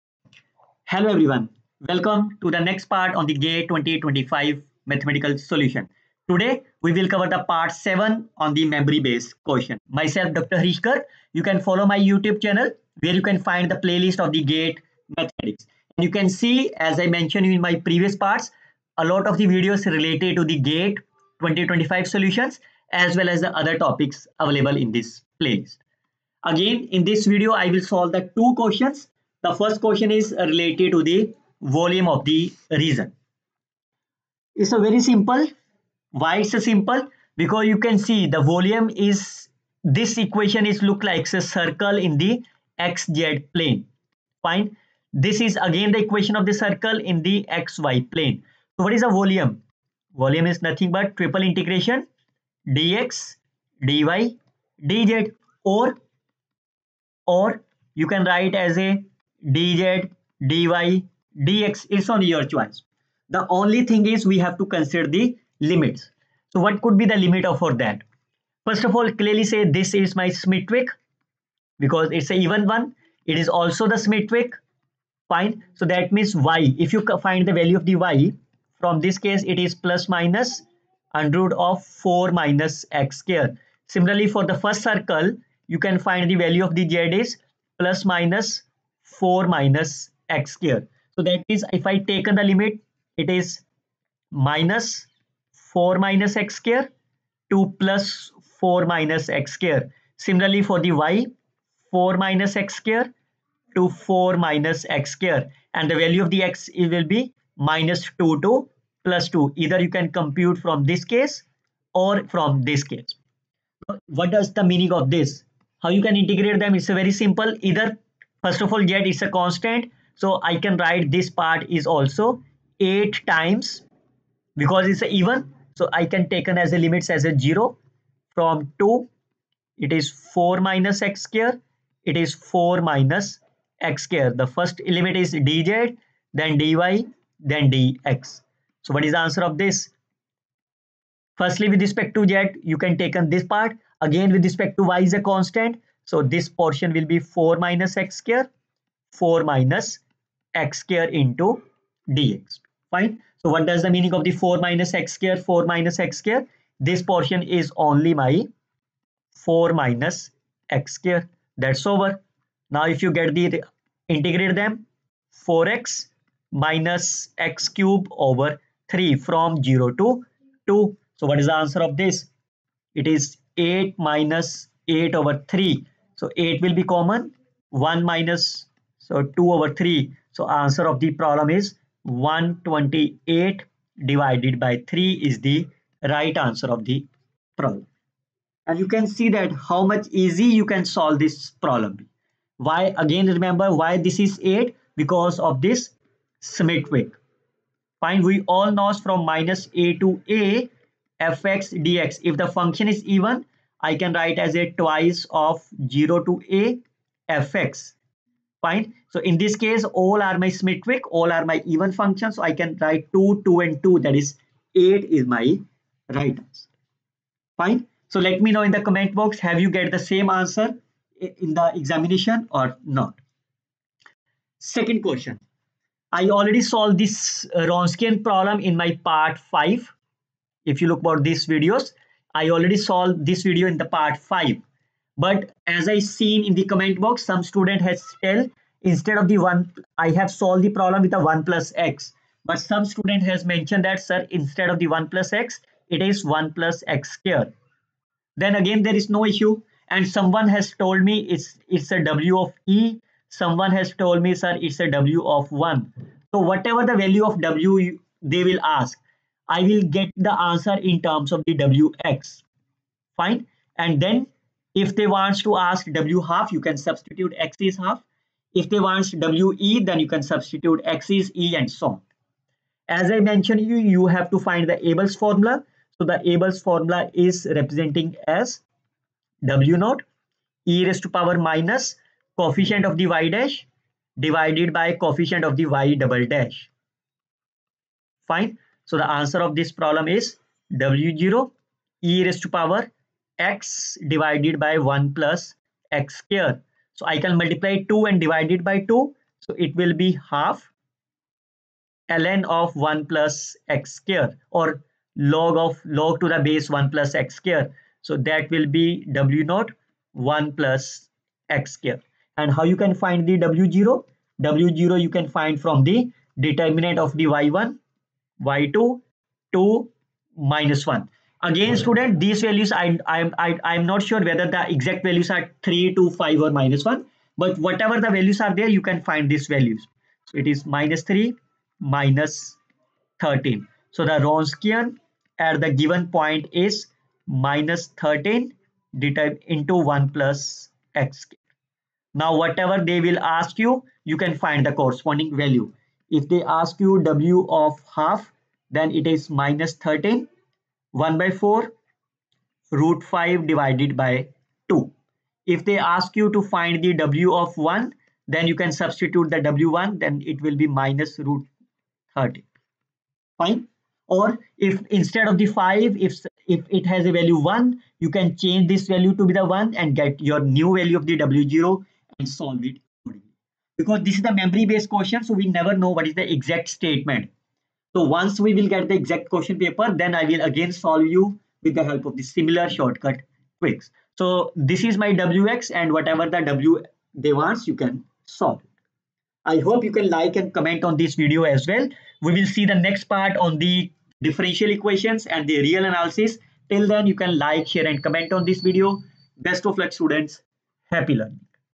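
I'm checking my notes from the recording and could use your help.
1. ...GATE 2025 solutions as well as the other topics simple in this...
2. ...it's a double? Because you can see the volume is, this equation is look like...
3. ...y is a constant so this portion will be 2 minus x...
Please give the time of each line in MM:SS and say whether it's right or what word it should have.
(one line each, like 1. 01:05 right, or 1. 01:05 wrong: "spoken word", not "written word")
1. 00:20 wrong: "available", not "simple"
2. 00:36 wrong: "simple", not "double"
3. 02:24 wrong: "4", not "2".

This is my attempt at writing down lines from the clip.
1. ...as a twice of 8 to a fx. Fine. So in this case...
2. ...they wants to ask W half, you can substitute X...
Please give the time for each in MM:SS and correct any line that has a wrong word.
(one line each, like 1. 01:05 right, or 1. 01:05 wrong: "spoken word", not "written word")
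1. 03:24 wrong: "0", not "8"
2. 04:24 right.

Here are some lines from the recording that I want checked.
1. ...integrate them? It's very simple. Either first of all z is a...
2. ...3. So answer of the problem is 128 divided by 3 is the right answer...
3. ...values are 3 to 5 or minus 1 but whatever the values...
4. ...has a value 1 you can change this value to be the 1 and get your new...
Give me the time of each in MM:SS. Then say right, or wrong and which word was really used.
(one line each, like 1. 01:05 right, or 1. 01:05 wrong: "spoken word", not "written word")
1. 01:56 right
2. 02:59 right
3. 05:25 right
4. 06:06 right.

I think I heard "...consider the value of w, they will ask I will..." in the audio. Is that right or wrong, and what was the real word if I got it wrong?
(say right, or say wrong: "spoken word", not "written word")
wrong: "whatever", not "consider".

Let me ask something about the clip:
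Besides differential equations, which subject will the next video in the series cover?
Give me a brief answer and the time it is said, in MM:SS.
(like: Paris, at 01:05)
Real analysis, at 06:35.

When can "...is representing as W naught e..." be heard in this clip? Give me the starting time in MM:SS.
04:37.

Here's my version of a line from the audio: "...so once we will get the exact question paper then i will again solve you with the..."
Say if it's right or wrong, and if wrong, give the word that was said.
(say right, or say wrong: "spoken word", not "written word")
right.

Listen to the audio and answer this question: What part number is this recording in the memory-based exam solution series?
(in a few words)
7.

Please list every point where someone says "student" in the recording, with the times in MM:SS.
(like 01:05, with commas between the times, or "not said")
03:57, 04:02, 05:21, 06:40.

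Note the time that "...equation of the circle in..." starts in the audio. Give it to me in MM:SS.
00:46.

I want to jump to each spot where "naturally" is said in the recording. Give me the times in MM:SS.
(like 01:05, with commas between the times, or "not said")
not said.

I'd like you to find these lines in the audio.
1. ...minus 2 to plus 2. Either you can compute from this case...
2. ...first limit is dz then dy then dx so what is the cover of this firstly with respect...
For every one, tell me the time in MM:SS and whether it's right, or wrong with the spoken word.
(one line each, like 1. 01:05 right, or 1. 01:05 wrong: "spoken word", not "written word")
1. 01:47 right
2. 02:14 wrong: "answer", not "cover".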